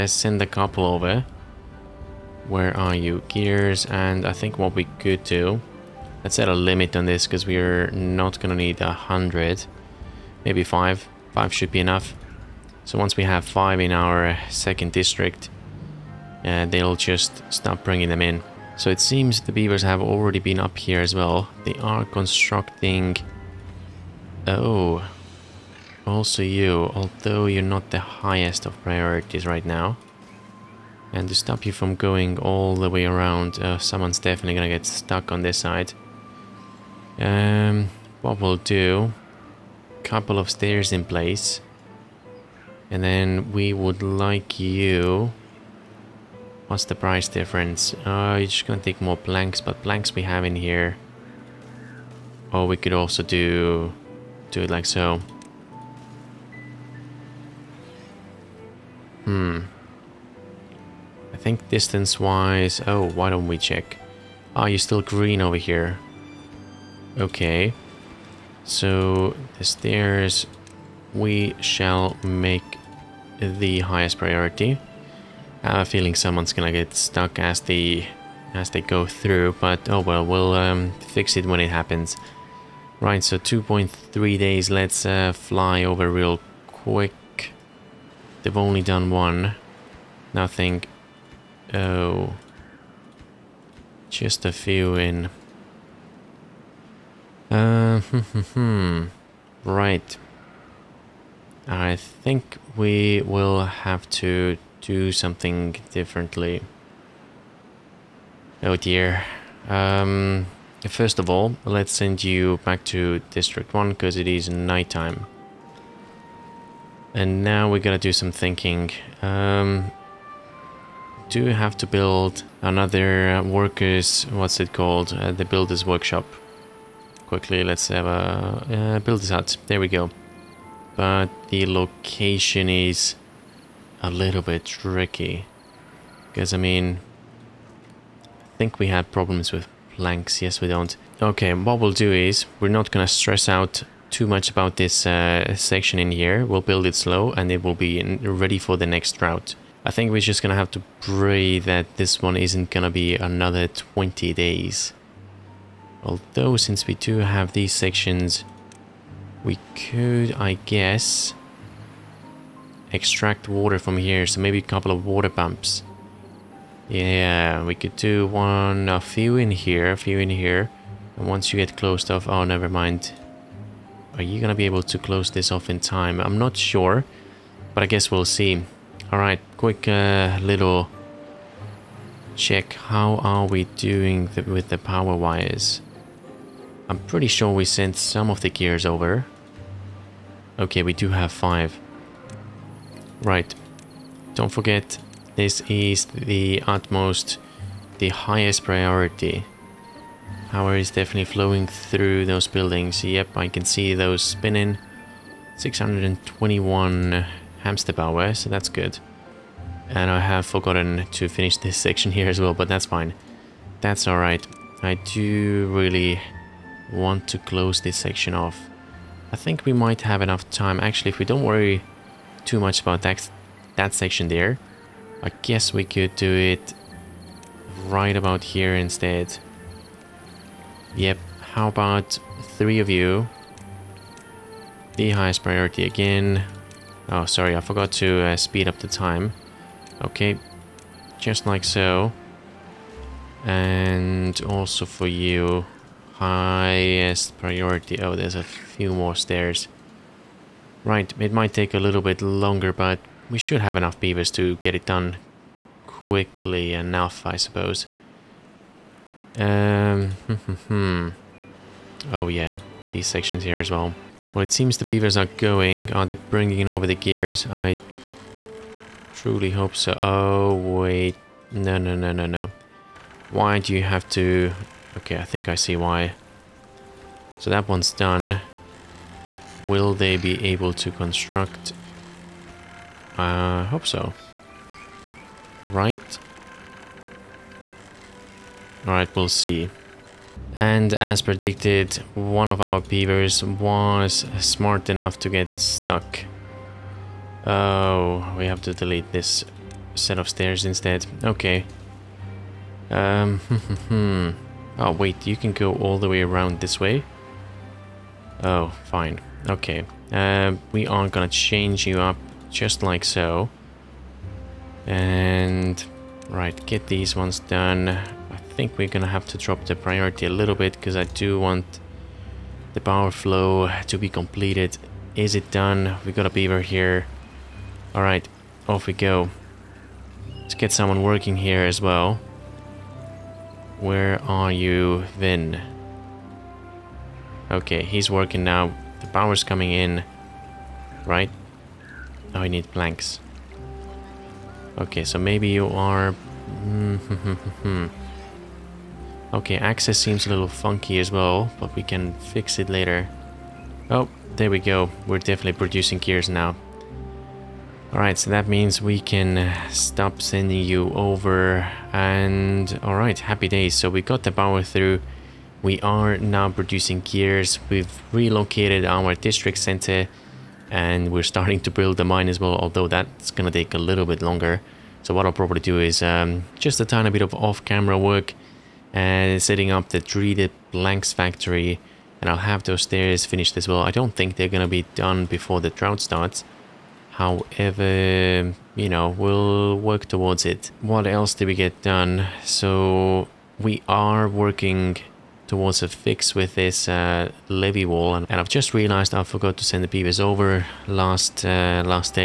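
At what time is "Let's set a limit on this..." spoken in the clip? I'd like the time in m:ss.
0:06.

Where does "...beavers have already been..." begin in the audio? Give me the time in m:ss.
0:19.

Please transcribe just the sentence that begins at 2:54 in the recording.
Are you gonna be able to close this off in time?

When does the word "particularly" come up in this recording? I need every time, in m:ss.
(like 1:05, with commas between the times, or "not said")
not said.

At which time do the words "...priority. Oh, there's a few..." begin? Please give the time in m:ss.
4:07.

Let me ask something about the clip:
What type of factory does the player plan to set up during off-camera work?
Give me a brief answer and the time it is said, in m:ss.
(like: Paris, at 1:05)
3D blanks factory, at 6:19.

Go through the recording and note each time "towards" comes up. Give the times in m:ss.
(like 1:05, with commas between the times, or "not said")
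6:30, 6:35.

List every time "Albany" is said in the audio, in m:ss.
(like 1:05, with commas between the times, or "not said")
not said.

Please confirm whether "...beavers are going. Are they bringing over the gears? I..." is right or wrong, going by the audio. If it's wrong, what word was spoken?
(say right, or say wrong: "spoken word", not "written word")
right.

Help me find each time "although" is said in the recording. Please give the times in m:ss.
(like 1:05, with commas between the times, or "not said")
0:26, 2:36, 6:12.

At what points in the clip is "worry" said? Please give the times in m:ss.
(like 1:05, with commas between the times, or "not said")
3:41.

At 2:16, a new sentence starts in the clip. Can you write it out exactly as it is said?
Because, I mean, I think we had problems with planks.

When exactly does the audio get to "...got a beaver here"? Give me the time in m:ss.
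5:26.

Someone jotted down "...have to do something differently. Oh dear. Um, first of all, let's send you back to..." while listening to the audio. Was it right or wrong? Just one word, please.
right.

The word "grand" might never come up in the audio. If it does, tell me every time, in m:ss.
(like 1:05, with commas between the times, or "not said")
not said.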